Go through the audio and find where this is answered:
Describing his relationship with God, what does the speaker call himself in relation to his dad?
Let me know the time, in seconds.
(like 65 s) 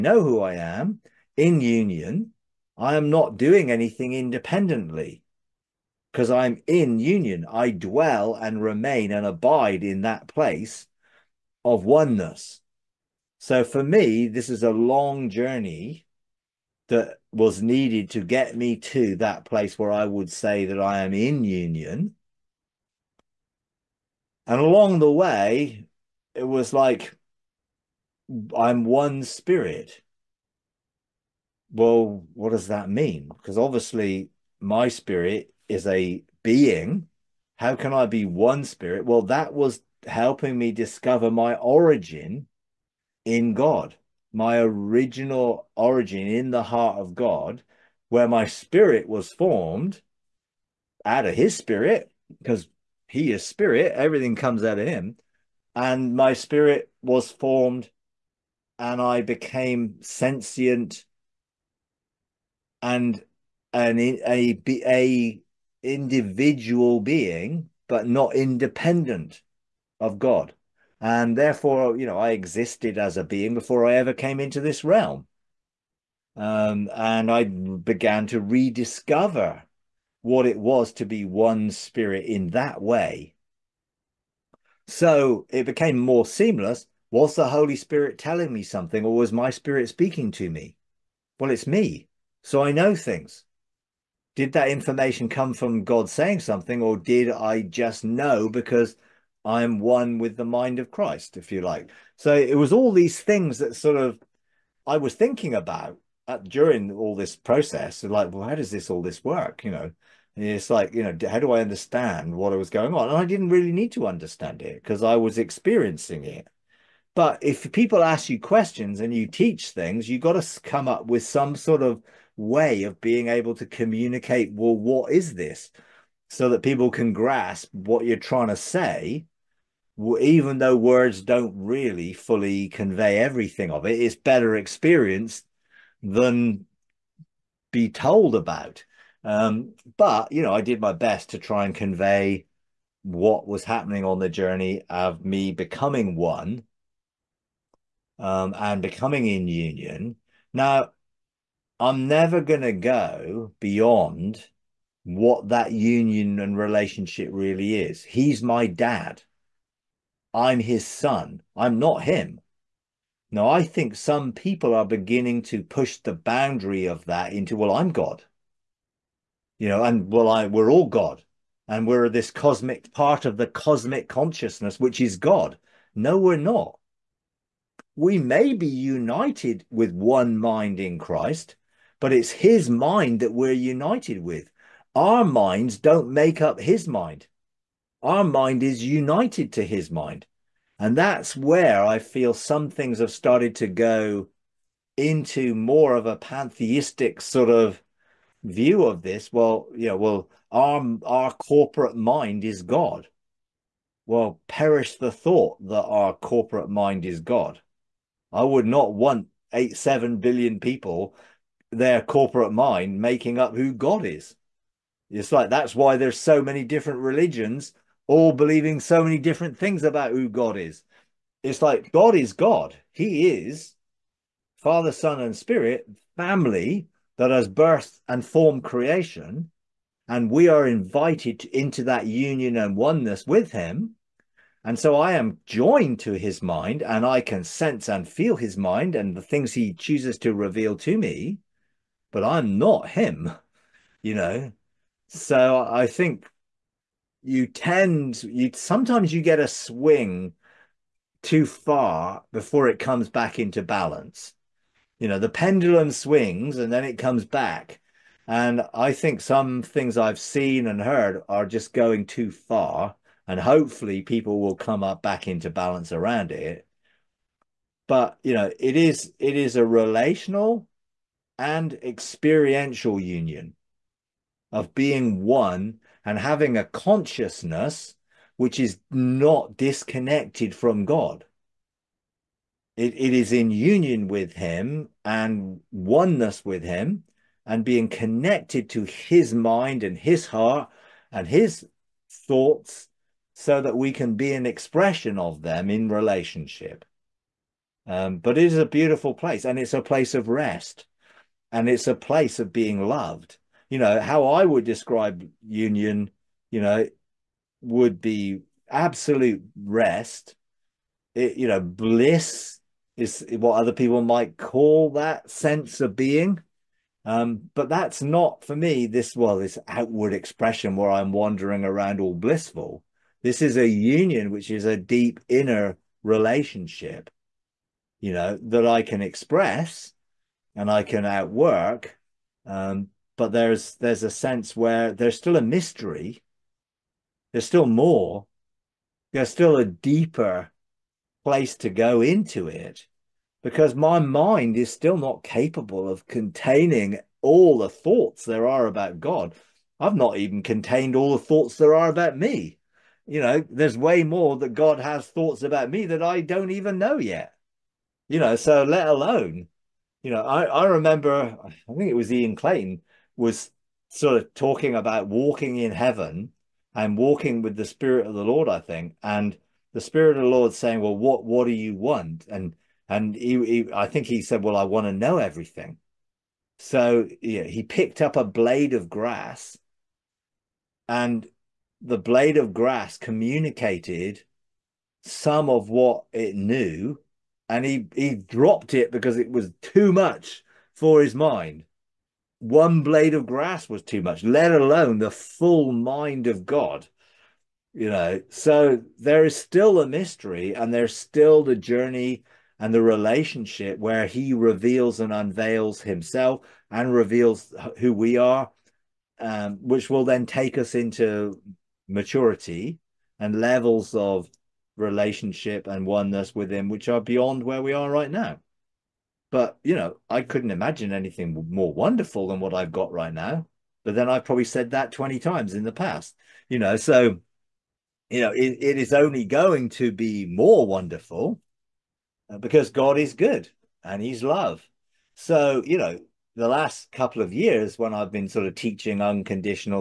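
160 s.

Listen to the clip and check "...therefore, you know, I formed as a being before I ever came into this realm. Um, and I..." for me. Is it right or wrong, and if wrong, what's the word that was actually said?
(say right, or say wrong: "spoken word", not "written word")
wrong: "existed", not "formed".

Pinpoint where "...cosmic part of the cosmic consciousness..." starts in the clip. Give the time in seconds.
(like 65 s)
172 s.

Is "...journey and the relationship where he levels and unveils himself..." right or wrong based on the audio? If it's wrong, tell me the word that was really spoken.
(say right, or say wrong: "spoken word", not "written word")
wrong: "reveals", not "levels".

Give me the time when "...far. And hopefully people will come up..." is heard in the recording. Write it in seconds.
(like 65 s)
262 s.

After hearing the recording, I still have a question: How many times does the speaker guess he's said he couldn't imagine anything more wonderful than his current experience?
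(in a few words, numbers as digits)
20.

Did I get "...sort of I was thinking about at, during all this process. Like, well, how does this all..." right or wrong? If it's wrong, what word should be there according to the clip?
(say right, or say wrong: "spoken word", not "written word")
right.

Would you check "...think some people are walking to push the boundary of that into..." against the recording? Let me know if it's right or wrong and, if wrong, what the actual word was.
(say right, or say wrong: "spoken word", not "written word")
wrong: "beginning", not "walking".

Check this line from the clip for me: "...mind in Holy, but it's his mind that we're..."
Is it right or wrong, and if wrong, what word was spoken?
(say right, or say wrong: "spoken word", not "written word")
wrong: "Christ", not "Holy".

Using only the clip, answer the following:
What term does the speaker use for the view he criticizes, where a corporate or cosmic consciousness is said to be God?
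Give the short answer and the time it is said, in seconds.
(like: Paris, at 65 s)
Pantheistic, at 196 s.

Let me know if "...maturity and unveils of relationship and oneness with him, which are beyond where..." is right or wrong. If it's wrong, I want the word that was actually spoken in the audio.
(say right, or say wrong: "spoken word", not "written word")
wrong: "levels", not "unveils".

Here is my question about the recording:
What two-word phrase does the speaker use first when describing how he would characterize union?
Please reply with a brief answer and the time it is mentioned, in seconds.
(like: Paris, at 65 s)
Absolute rest, at 308 s.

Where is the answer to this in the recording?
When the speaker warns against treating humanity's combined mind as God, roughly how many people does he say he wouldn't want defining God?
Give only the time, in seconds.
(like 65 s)
209 s.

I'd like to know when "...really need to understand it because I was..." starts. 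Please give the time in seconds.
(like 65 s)
113 s.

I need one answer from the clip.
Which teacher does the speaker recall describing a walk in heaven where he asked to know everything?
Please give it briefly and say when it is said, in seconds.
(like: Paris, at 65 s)
Ian Clayton, at 362 s.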